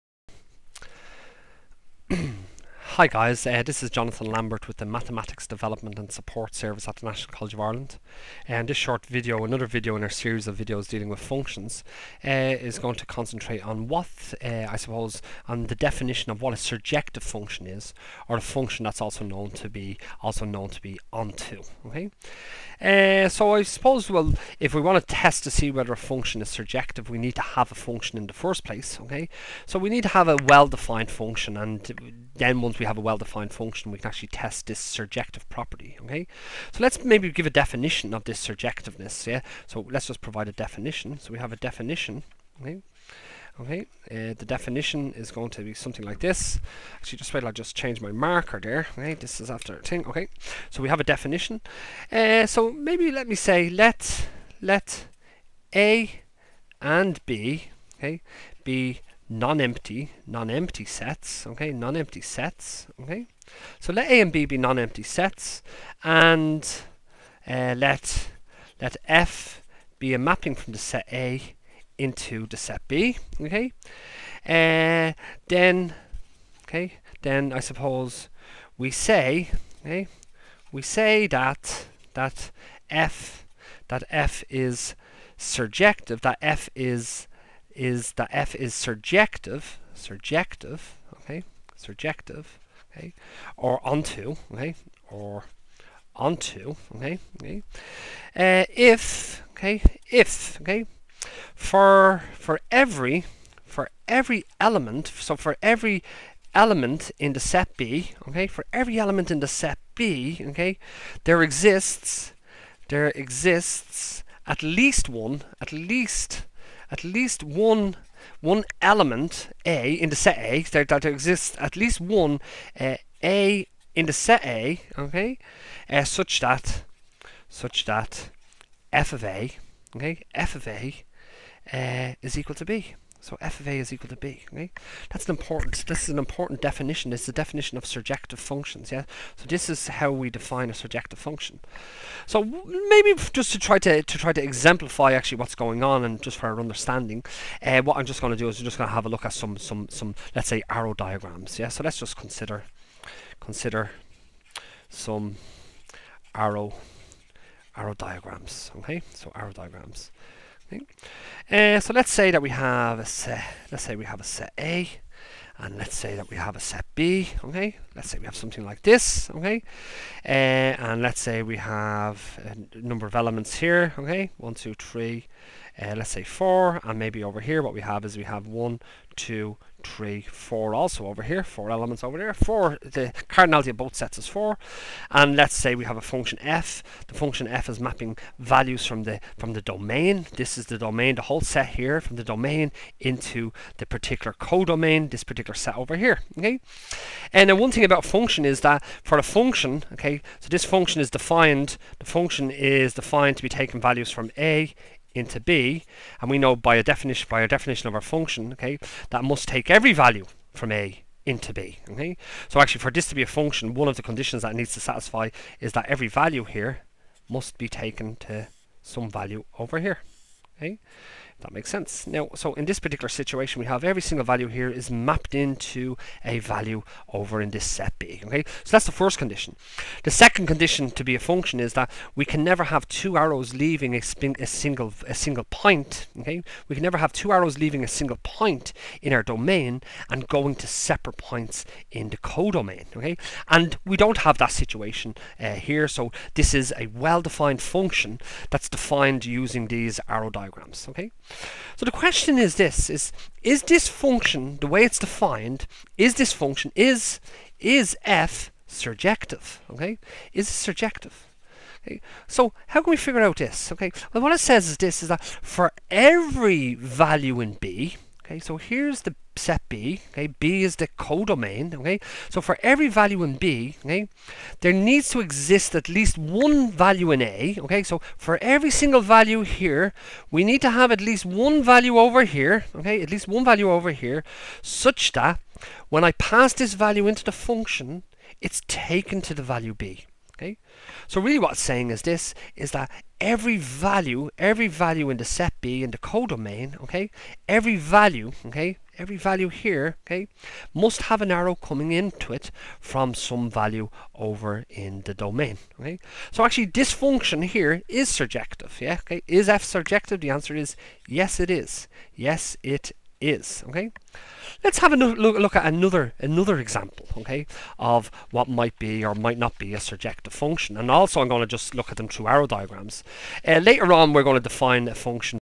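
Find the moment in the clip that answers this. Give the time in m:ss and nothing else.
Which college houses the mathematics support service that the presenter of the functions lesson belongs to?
0:07.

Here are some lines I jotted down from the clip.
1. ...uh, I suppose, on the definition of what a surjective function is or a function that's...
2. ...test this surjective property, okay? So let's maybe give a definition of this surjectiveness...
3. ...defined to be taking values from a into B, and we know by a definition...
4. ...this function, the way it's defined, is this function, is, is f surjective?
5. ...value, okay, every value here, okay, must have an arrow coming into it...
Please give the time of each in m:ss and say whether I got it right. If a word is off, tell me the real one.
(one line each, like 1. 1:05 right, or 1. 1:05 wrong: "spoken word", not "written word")
1. 0:14 right
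2. 0:34 right
3. 3:22 right
4. 4:13 right
5. 4:57 right.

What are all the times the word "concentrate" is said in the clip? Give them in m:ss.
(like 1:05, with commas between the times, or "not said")
0:13.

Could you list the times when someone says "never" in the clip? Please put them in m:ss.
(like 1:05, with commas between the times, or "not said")
3:52, 3:56.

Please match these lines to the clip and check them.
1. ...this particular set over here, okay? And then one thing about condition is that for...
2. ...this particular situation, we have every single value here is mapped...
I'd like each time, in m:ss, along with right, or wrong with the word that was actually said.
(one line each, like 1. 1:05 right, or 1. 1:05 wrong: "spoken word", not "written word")
1. 3:15 wrong: "function", not "condition"
2. 3:42 right.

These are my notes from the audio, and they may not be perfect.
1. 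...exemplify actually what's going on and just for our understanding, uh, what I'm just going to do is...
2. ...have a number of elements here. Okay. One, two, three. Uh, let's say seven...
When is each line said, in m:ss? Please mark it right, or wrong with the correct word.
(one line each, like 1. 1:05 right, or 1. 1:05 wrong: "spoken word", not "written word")
1. 2:24 right
2. 2:51 wrong: "four", not "seven".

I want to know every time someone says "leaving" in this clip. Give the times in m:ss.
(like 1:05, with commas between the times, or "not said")
3:53, 3:57.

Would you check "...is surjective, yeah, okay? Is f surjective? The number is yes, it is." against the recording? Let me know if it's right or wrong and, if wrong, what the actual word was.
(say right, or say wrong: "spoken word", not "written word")
wrong: "answer", not "number".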